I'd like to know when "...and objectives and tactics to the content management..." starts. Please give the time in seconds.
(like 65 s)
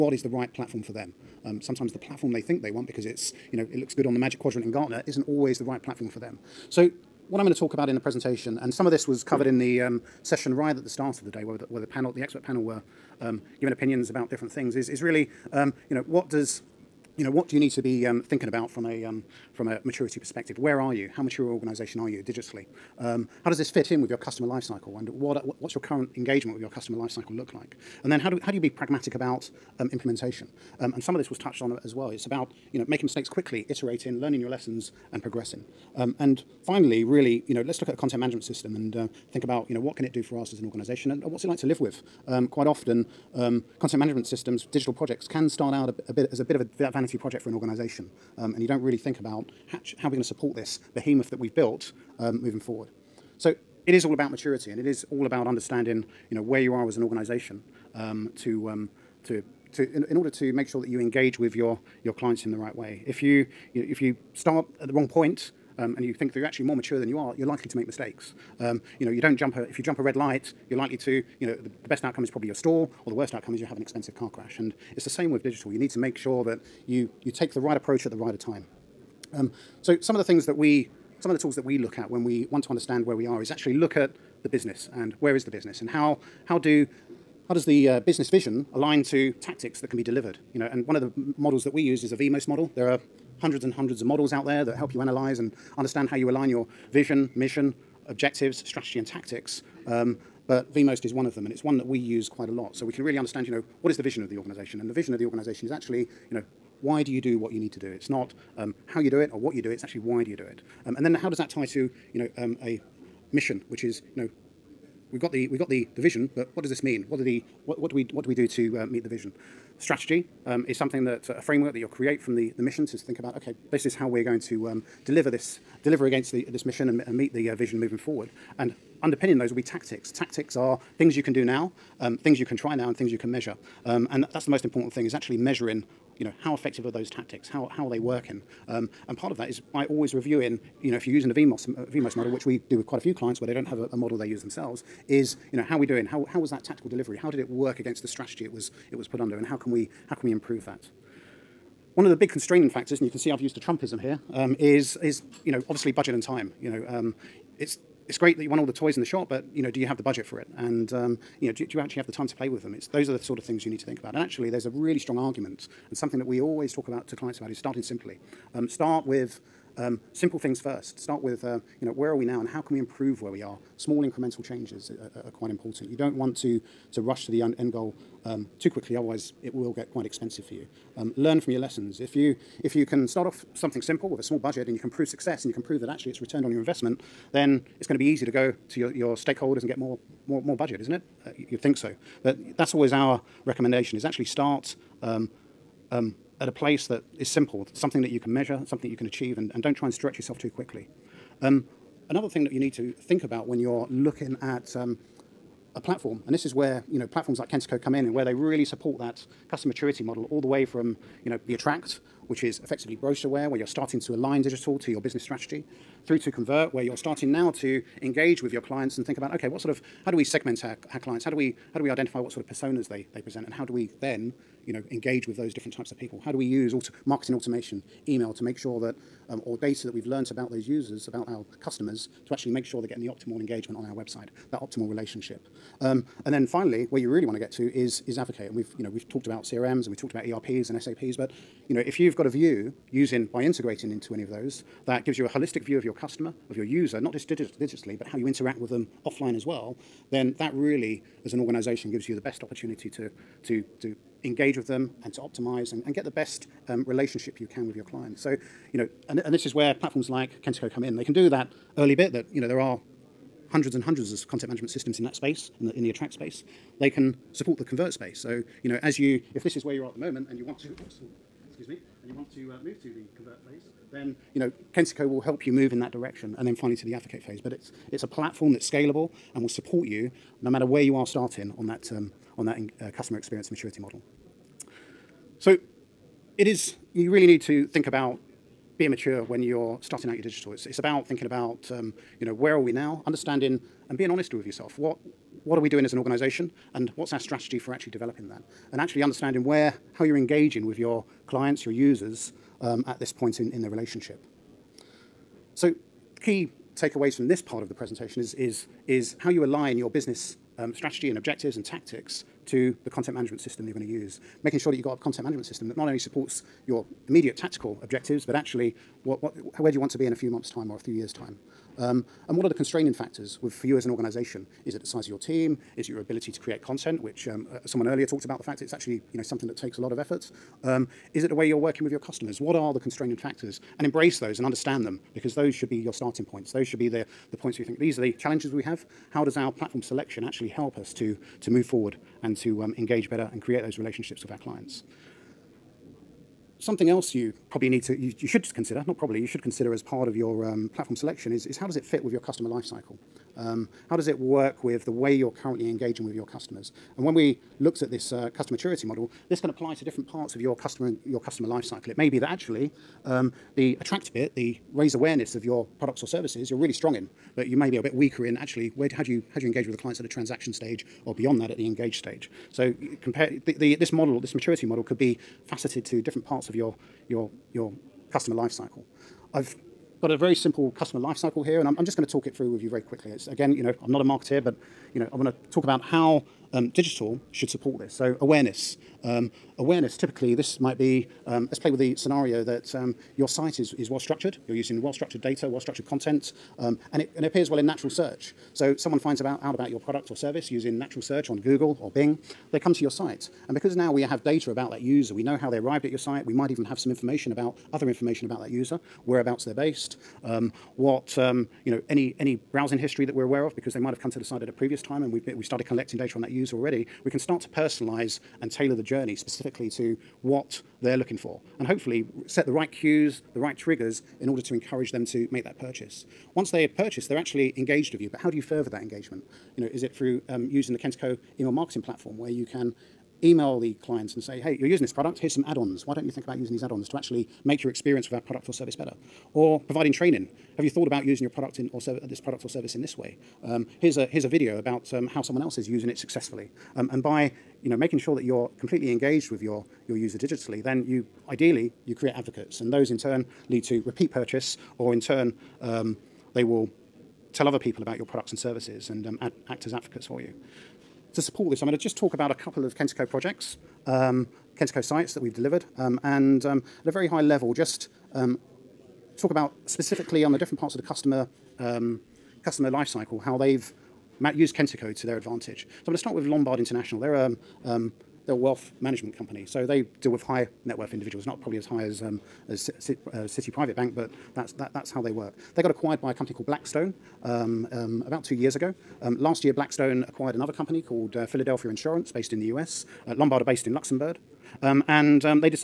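311 s.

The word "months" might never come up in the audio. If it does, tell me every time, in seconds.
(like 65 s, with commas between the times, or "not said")
320 s.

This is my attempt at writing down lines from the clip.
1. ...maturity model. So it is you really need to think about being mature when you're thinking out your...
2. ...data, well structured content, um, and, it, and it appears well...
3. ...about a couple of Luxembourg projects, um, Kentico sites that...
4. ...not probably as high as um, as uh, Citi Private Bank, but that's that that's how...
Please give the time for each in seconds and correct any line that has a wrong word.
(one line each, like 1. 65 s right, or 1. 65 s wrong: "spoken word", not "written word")
1. 283 s wrong: "starting", not "thinking"
2. 395 s right
3. 462 s wrong: "Kentico", not "Luxembourg"
4. 481 s right.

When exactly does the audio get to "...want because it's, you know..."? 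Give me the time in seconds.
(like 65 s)
2 s.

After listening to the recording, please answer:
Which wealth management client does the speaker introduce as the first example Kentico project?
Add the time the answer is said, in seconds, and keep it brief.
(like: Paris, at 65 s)
Lombard International, at 476 s.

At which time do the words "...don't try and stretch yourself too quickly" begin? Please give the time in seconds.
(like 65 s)
199 s.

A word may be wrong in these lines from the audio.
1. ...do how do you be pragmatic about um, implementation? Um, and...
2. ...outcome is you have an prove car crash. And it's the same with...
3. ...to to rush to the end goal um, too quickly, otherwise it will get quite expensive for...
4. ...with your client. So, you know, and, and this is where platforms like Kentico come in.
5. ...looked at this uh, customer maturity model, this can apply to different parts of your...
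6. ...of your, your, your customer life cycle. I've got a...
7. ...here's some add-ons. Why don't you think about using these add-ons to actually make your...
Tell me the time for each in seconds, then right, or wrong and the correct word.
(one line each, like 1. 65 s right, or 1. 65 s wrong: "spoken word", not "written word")
1. 28 s right
2. 73 s wrong: "expensive", not "prove"
3. 176 s right
4. 257 s right
5. 357 s right
6. 376 s right
7. 435 s right.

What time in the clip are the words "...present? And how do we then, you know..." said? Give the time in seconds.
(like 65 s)
223 s.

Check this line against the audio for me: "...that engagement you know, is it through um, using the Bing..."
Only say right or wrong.
wrong.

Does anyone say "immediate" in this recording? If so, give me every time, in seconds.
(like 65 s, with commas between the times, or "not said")
317 s.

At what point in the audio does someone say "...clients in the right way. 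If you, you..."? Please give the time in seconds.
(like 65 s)
62 s.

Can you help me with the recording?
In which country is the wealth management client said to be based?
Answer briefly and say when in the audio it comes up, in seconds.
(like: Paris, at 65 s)
Luxembourg, at 493 s.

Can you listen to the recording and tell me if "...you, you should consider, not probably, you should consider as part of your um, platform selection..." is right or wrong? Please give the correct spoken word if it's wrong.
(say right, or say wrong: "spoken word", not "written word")
right.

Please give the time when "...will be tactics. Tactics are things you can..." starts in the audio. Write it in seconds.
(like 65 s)
129 s.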